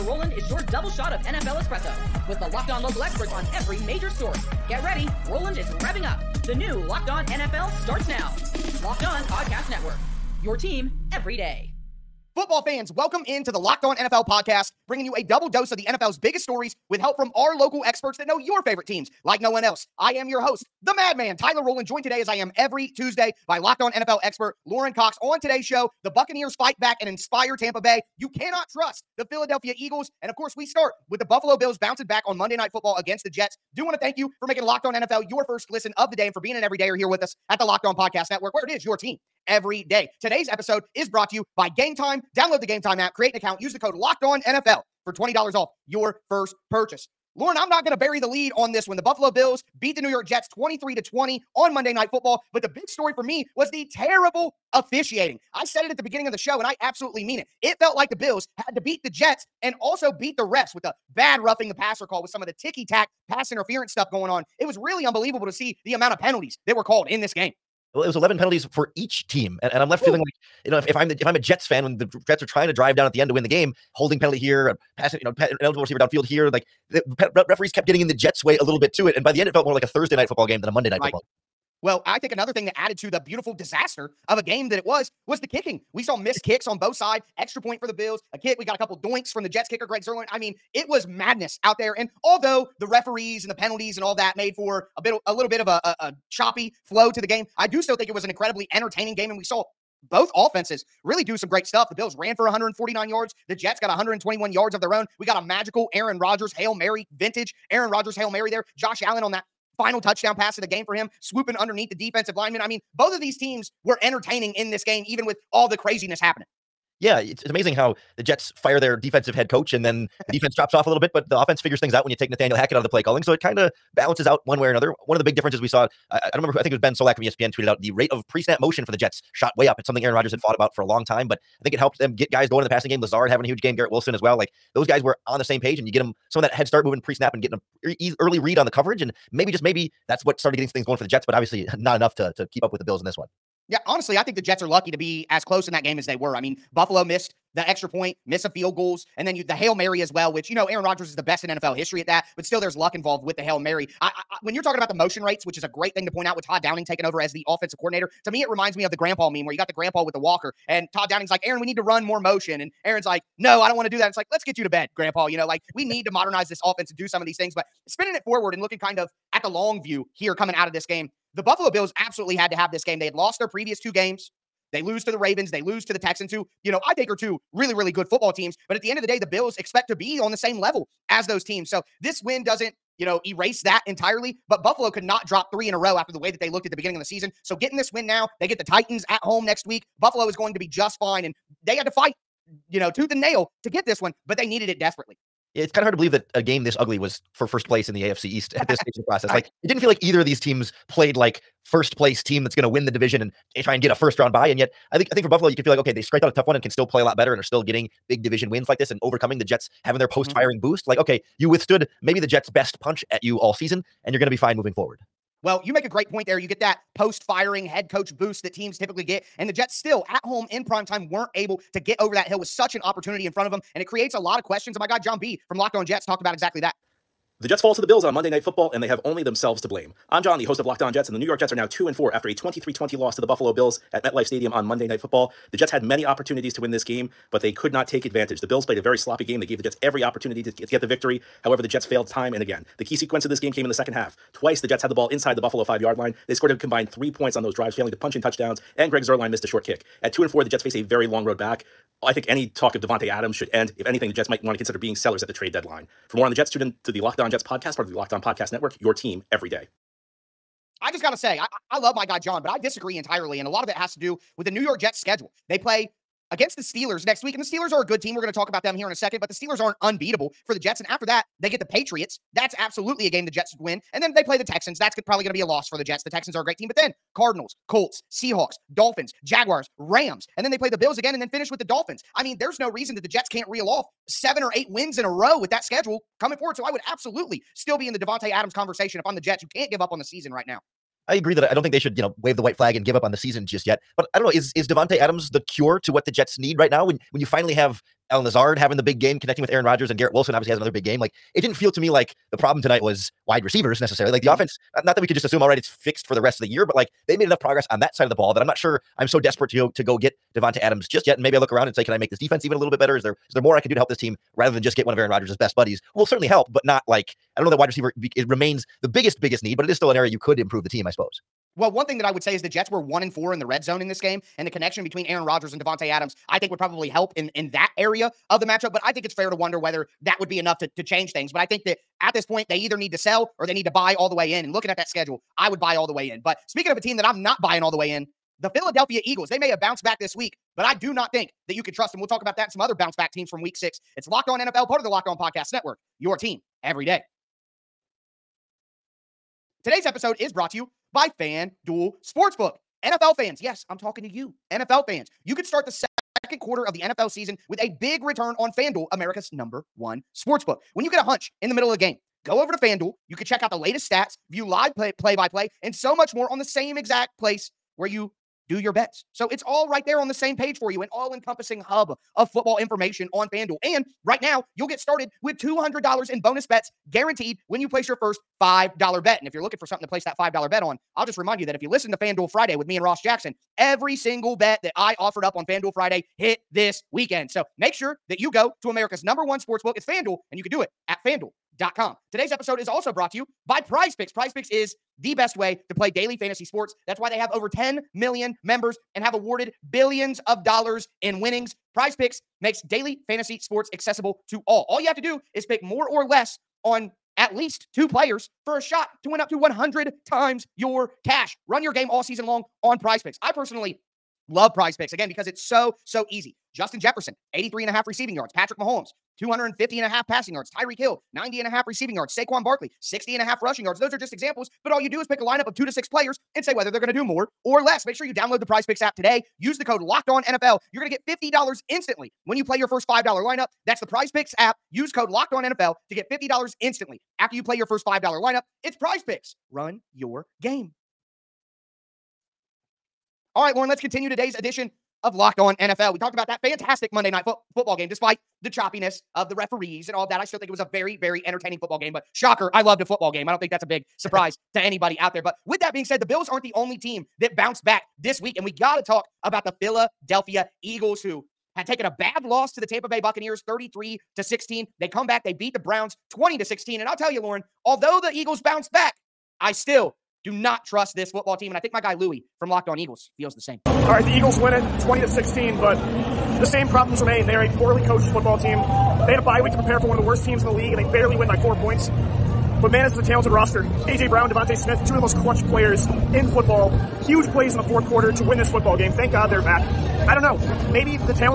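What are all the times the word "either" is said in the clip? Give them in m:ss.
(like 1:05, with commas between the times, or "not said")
3:20, 5:32.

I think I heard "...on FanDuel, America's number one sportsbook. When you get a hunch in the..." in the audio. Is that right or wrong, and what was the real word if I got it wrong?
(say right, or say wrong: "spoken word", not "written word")
right.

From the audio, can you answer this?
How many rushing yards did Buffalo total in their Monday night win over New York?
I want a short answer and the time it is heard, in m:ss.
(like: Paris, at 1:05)
149, at 1:42.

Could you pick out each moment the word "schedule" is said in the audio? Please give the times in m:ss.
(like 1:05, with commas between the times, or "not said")
4:24, 4:45, 5:34.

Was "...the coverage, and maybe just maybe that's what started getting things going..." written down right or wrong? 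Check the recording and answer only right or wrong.
right.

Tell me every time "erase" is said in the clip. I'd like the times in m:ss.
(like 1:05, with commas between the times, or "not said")
3:03.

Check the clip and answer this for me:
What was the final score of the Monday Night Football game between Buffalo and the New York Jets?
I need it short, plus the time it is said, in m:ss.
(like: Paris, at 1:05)
23-20, at 0:50.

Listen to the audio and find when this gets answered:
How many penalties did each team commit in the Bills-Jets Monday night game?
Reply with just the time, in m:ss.
1:08.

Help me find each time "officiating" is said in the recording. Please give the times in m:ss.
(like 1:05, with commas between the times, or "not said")
0:54.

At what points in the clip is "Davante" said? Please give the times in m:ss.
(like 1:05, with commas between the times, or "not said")
4:12, 4:47, 4:54, 5:10, 5:25.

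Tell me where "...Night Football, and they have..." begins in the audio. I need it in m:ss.
3:48.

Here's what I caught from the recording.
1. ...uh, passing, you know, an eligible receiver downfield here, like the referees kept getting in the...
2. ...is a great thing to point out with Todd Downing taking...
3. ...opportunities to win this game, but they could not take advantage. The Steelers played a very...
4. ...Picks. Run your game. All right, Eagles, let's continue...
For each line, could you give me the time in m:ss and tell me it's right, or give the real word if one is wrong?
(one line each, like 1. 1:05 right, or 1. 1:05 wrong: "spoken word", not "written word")
1. 1:14 right
2. 2:35 right
3. 3:56 wrong: "Bills", not "Steelers"
4. 7:19 wrong: "Lauren", not "Eagles".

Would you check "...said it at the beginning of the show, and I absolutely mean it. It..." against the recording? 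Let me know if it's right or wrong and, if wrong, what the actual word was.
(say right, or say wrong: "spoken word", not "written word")
right.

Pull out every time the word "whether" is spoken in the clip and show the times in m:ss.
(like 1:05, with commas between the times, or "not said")
5:29, 7:06.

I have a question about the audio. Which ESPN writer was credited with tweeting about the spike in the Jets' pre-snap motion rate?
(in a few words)
Ben Solak.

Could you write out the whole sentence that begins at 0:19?
I am your host, the madman, Tyler Rowland, joined today as I am every Tuesday by locked on NFL expert Lauren Cox.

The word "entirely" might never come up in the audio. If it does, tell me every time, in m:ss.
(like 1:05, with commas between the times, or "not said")
3:03, 4:22.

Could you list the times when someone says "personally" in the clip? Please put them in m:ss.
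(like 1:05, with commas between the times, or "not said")
6:53.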